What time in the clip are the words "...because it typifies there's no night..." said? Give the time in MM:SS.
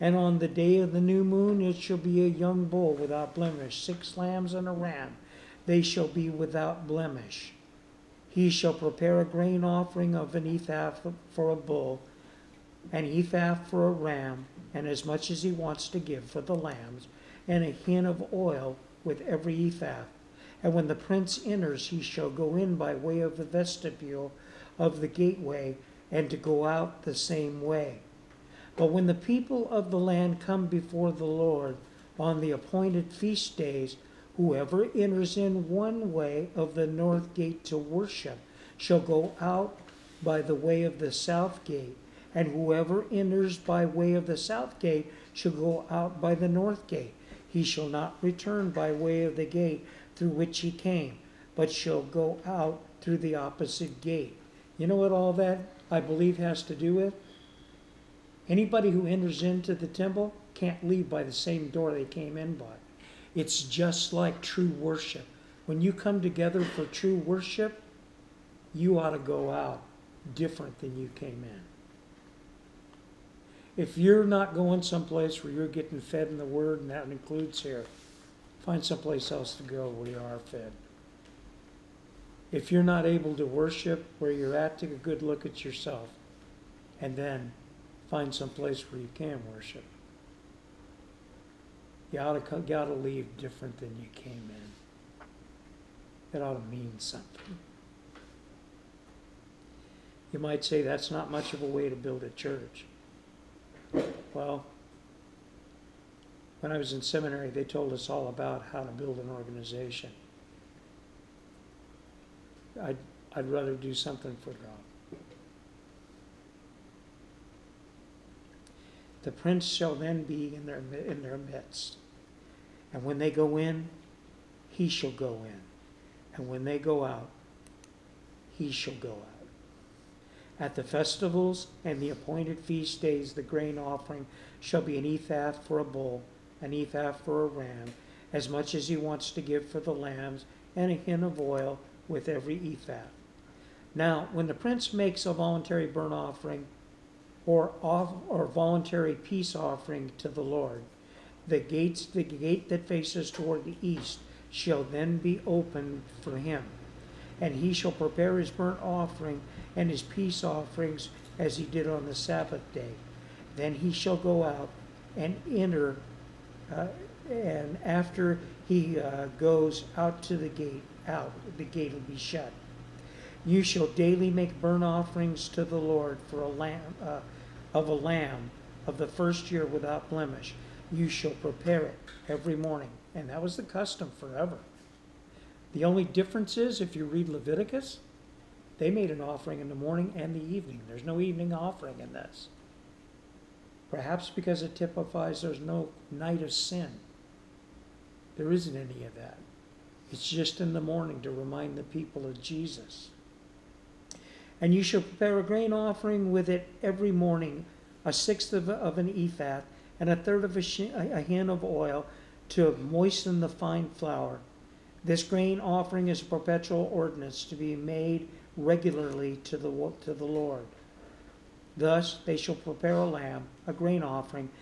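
03:14.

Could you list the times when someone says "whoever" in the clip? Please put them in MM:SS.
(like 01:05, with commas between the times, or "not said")
00:34, 00:42.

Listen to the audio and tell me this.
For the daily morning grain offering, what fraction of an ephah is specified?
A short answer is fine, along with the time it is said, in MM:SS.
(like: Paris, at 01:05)
a sixth, at 03:28.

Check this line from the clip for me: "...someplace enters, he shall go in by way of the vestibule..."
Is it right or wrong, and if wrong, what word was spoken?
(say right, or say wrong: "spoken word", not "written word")
wrong: "prince", not "someplace".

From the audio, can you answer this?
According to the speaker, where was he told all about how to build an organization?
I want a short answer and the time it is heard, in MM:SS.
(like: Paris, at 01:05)
seminary, at 01:47.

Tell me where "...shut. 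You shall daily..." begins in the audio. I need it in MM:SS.
02:52.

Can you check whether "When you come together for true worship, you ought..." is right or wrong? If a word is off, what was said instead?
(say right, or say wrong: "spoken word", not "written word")
right.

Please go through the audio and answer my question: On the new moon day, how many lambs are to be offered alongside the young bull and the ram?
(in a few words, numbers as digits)
6.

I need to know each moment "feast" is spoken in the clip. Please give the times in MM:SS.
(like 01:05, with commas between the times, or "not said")
00:33, 02:12.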